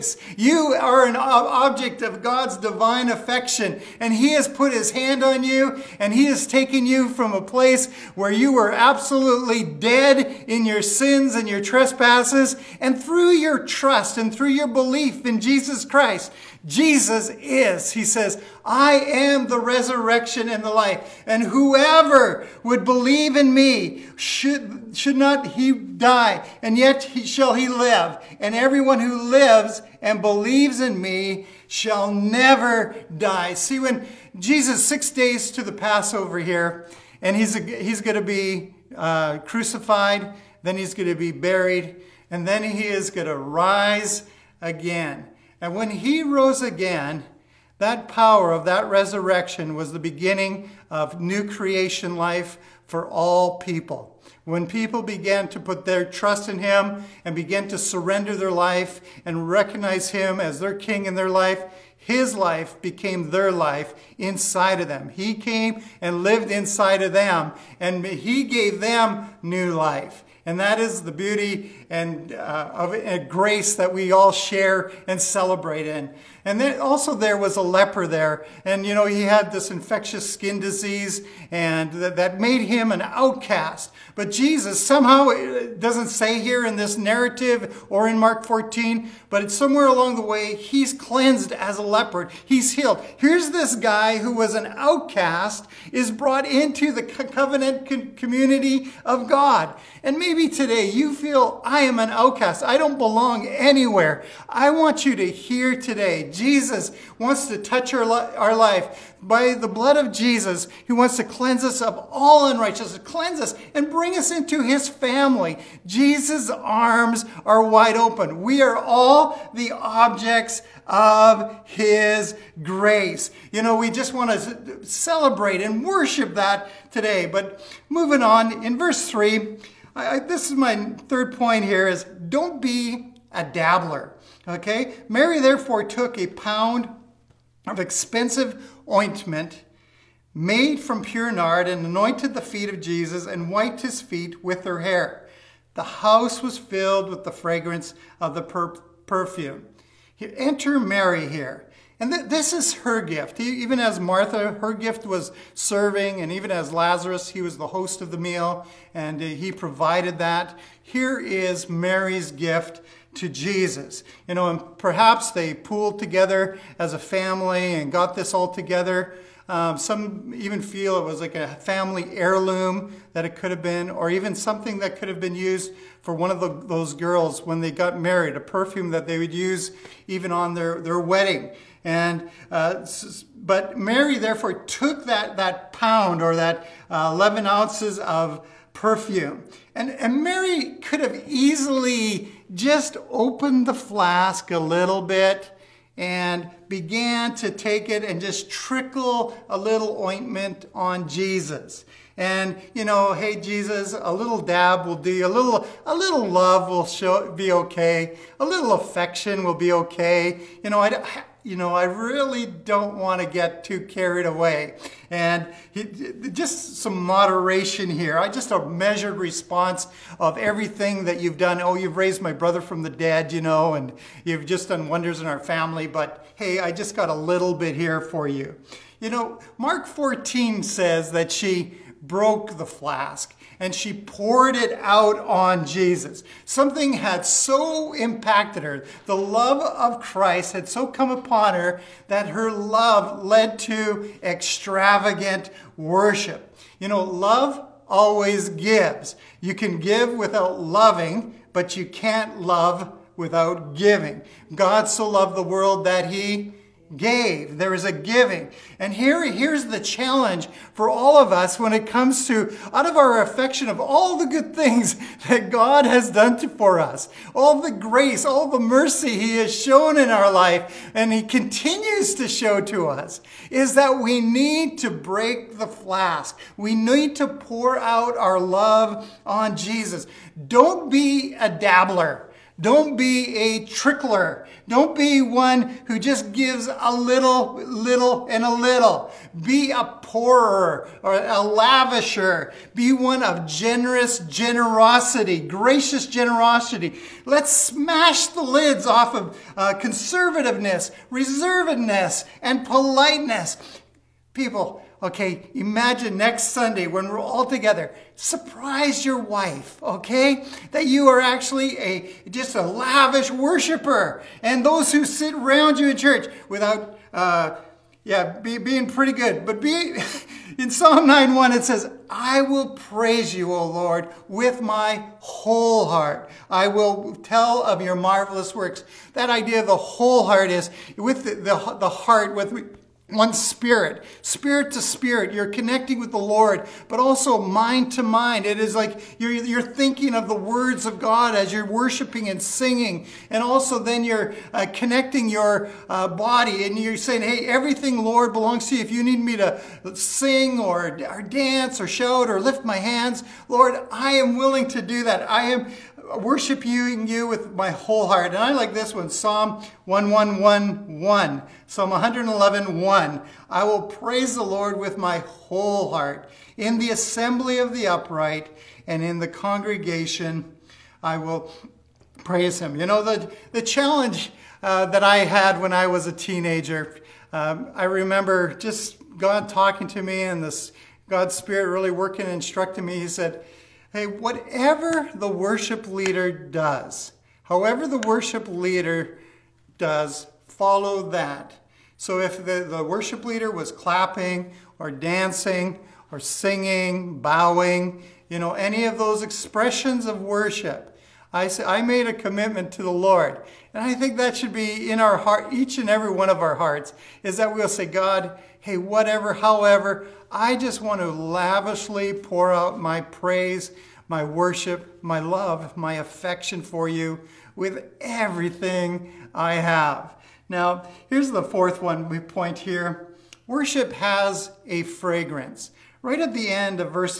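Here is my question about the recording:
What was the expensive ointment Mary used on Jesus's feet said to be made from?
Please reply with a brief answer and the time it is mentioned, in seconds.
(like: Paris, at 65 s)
pure nard, at 141 s.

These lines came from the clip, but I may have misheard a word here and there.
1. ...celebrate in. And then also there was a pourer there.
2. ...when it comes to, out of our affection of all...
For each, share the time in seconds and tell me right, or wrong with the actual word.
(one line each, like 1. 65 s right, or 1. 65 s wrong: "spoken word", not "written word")
1. 75 s wrong: "leper", not "pourer"
2. 261 s right.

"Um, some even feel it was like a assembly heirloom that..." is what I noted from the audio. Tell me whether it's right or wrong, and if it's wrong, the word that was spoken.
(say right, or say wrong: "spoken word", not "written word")
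wrong: "family", not "assembly".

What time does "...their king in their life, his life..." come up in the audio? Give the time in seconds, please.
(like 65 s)
60 s.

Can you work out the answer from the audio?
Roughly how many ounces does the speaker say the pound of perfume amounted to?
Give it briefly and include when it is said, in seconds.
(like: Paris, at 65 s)
11, at 187 s.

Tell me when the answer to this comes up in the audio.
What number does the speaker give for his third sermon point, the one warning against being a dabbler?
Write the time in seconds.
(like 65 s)
131 s.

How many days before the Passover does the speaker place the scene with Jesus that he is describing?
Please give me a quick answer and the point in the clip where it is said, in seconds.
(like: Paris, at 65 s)
6, at 34 s.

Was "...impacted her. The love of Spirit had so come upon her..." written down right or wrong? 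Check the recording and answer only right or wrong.
wrong.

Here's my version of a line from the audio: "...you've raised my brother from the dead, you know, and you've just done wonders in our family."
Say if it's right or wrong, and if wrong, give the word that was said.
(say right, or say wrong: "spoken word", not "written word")
right.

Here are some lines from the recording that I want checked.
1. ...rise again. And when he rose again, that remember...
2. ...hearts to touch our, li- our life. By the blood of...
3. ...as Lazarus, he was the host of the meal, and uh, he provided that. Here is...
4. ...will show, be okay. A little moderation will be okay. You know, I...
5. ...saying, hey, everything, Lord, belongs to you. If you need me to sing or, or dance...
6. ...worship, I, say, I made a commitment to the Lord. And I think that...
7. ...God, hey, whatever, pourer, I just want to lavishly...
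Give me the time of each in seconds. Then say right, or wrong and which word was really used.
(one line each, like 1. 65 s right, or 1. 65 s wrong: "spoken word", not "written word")
1. 43 s wrong: "power", not "remember"
2. 107 s wrong: "wants", not "hearts"
3. 156 s right
4. 206 s wrong: "affection", not "moderation"
5. 346 s right
6. 400 s right
7. 407 s wrong: "however", not "pourer".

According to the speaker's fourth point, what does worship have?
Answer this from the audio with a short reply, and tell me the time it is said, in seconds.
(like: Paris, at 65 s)
A fragrance, at 424 s.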